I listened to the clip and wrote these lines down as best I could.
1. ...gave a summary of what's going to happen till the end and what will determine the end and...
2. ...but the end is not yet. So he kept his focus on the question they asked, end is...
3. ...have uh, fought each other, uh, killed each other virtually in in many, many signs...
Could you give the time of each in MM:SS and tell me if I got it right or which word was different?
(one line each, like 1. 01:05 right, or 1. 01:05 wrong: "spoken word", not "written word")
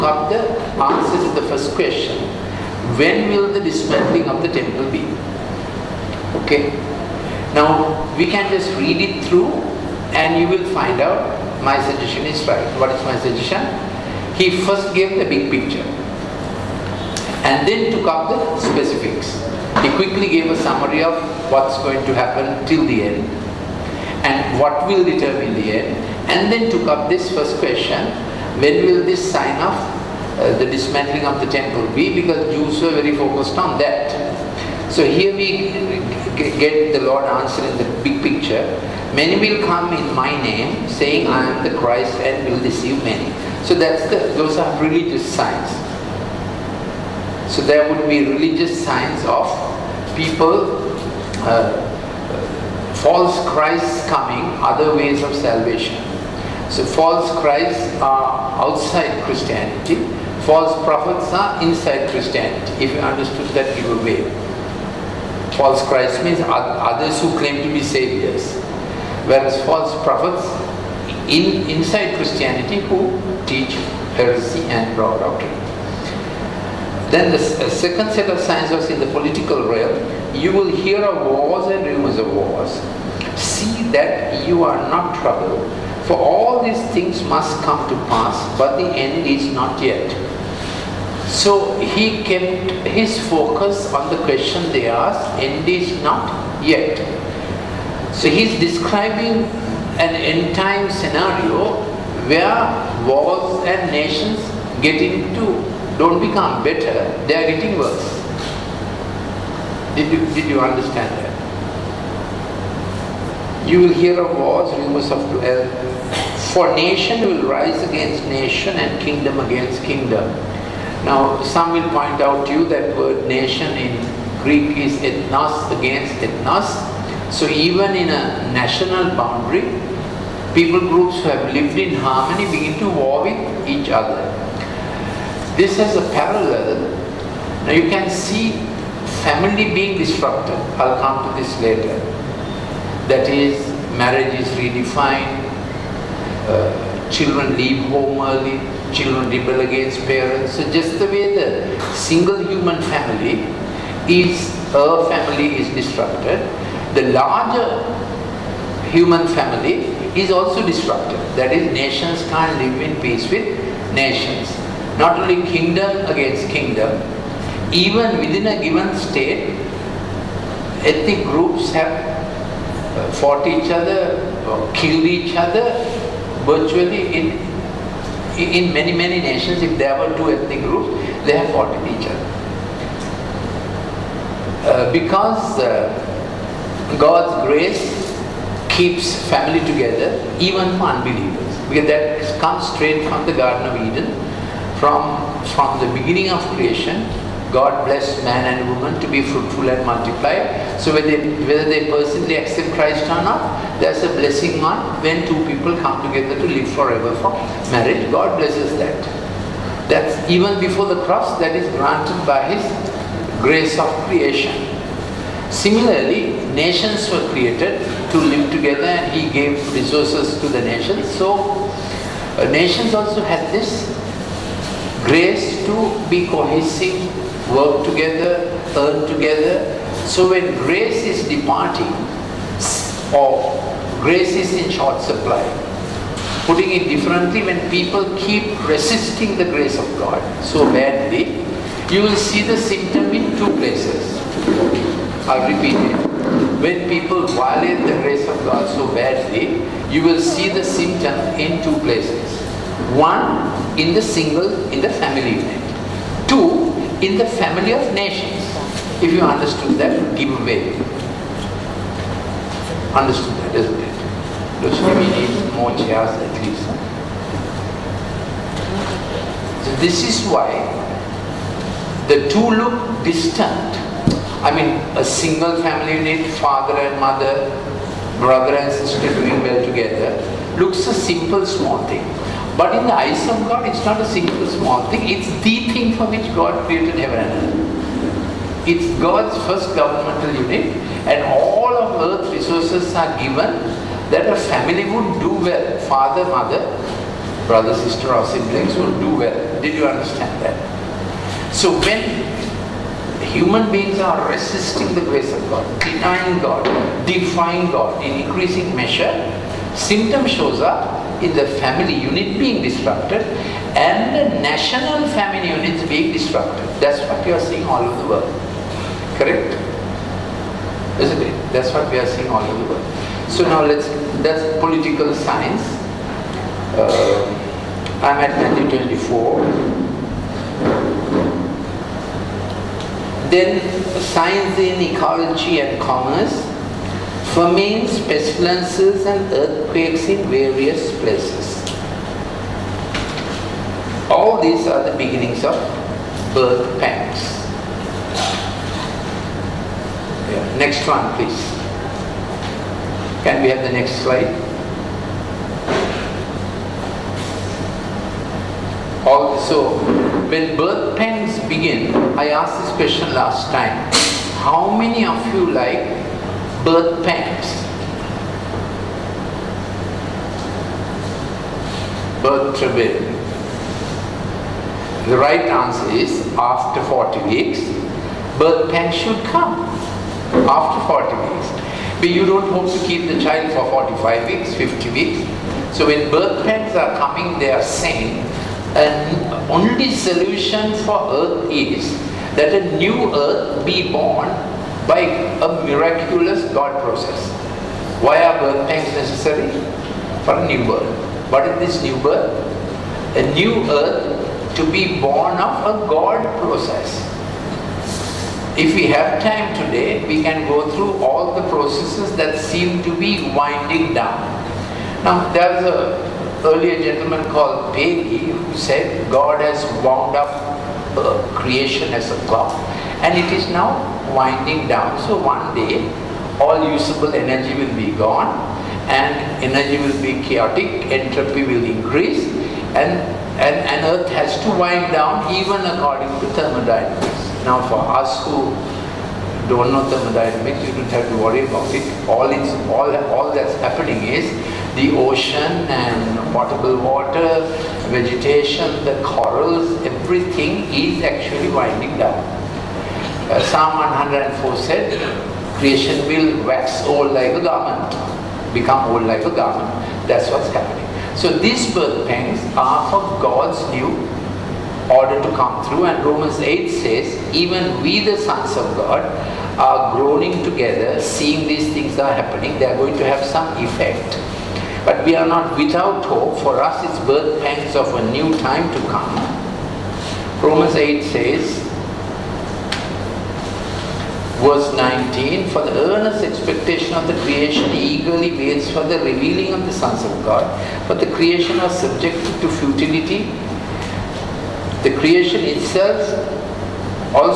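1. 00:20 right
2. 01:28 right
3. 02:51 wrong: "nations", not "signs".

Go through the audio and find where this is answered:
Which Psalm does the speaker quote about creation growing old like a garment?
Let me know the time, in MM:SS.
07:33.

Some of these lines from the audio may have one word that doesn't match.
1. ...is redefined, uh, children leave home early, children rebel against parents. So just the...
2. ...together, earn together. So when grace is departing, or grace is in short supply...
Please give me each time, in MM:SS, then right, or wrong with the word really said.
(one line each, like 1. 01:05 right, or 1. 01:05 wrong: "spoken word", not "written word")
1. 02:24 right
2. 03:47 right.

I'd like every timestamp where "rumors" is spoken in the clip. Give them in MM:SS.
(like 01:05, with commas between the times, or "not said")
01:21, 01:54.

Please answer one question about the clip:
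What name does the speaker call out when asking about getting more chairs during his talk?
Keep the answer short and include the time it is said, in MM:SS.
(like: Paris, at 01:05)
Lucifer, at 04:24.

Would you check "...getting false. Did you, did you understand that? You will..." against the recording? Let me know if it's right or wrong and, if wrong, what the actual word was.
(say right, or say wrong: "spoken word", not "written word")
wrong: "worse", not "false".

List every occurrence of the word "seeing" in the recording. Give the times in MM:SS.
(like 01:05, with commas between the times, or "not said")
05:17, 05:22, 07:50.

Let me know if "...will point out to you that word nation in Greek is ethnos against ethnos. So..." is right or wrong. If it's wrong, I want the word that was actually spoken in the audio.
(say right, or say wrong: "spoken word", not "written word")
right.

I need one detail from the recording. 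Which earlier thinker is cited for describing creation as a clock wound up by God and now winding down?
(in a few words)
Paley.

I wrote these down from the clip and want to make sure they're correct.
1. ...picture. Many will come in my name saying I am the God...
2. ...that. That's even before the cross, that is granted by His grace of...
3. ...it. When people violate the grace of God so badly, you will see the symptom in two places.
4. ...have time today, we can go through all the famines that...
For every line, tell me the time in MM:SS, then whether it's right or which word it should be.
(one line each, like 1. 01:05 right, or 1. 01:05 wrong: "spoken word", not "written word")
1. 00:38 wrong: "Christ", not "God"
2. 03:28 right
3. 04:05 right
4. 06:48 wrong: "processes", not "famines".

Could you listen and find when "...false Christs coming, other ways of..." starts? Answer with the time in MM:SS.
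00:52.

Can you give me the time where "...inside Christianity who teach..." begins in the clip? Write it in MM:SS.
01:11.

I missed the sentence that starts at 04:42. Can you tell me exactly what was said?
But in the eyes of God, it's not a single small thing.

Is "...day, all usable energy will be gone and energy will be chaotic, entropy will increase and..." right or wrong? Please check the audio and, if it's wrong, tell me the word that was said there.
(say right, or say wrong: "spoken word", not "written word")
right.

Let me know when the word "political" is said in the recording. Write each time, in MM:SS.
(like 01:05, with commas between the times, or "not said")
01:19, 05:24.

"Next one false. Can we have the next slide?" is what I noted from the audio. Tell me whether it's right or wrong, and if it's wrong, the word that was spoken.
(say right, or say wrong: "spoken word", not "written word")
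wrong: "please", not "false".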